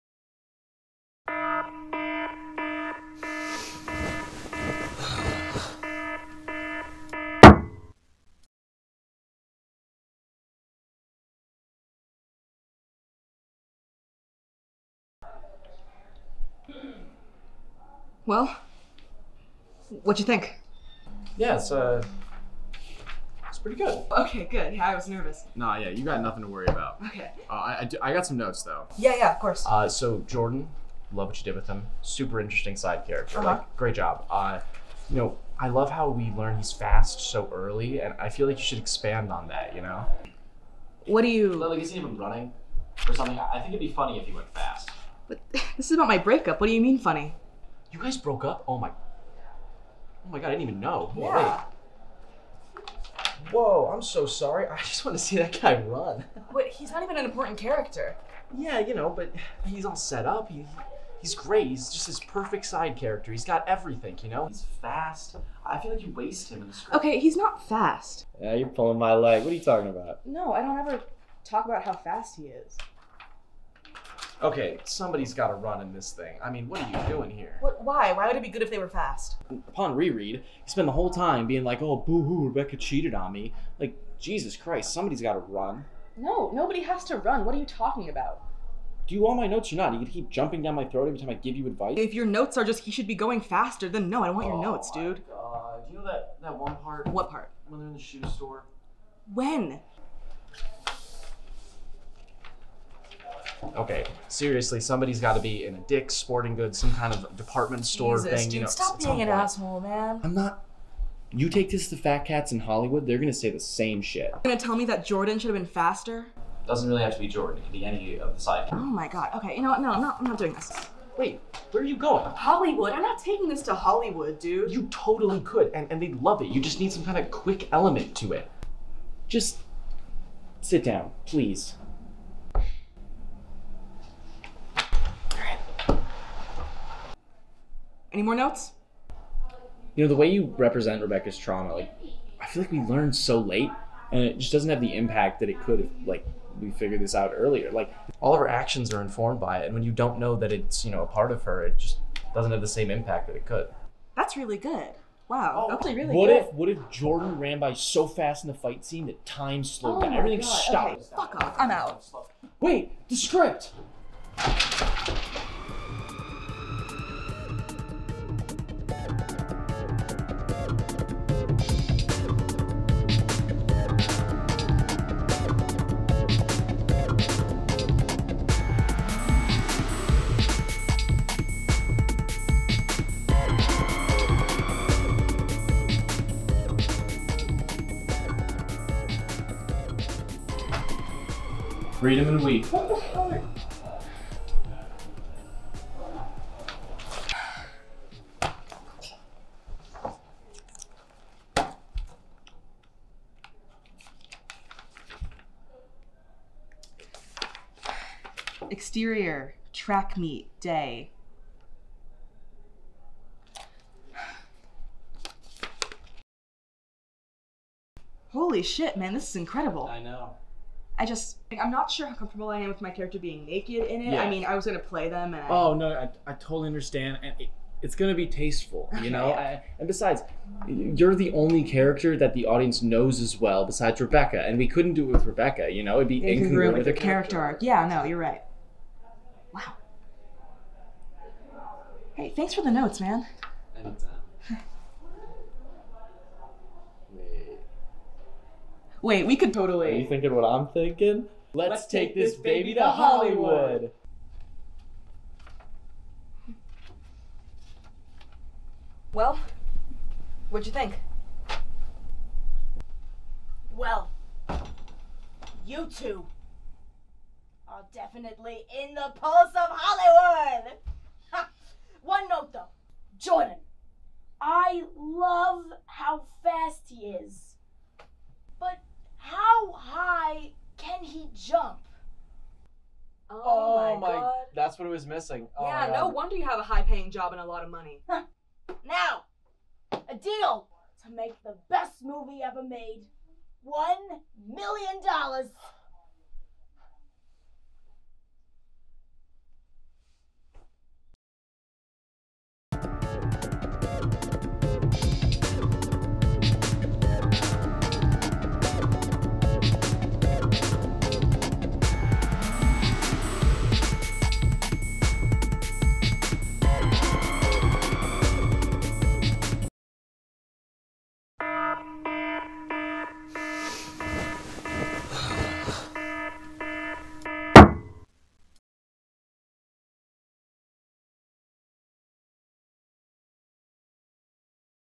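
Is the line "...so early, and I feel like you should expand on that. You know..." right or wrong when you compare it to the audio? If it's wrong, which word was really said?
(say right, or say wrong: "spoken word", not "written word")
right.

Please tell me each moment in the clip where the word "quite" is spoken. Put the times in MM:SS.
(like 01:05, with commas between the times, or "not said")
not said.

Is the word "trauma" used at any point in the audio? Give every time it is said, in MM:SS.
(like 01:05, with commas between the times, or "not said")
02:21.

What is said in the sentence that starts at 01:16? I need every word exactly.
I mean, what are you doing here?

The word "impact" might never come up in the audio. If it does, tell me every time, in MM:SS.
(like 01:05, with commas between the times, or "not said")
02:24, 02:32.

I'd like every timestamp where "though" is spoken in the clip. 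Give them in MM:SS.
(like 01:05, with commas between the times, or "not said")
00:28, 04:32.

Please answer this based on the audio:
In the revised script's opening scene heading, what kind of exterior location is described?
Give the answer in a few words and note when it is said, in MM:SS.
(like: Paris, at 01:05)
Track meet, at 03:29.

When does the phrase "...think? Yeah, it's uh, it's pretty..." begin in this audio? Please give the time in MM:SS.
00:20.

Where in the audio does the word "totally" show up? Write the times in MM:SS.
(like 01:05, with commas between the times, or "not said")
02:04, 03:46, 04:09.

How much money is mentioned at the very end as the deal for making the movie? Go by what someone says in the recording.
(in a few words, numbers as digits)
$1,000,000.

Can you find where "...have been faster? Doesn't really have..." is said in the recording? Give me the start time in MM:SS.
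01:55.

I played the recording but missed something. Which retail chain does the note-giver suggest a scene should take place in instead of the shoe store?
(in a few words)
Dick's Sporting Goods.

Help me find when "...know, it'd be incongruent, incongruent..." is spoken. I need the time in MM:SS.
03:55.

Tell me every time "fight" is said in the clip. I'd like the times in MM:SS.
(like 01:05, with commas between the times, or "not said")
02:38.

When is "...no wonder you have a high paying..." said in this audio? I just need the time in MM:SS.
04:45.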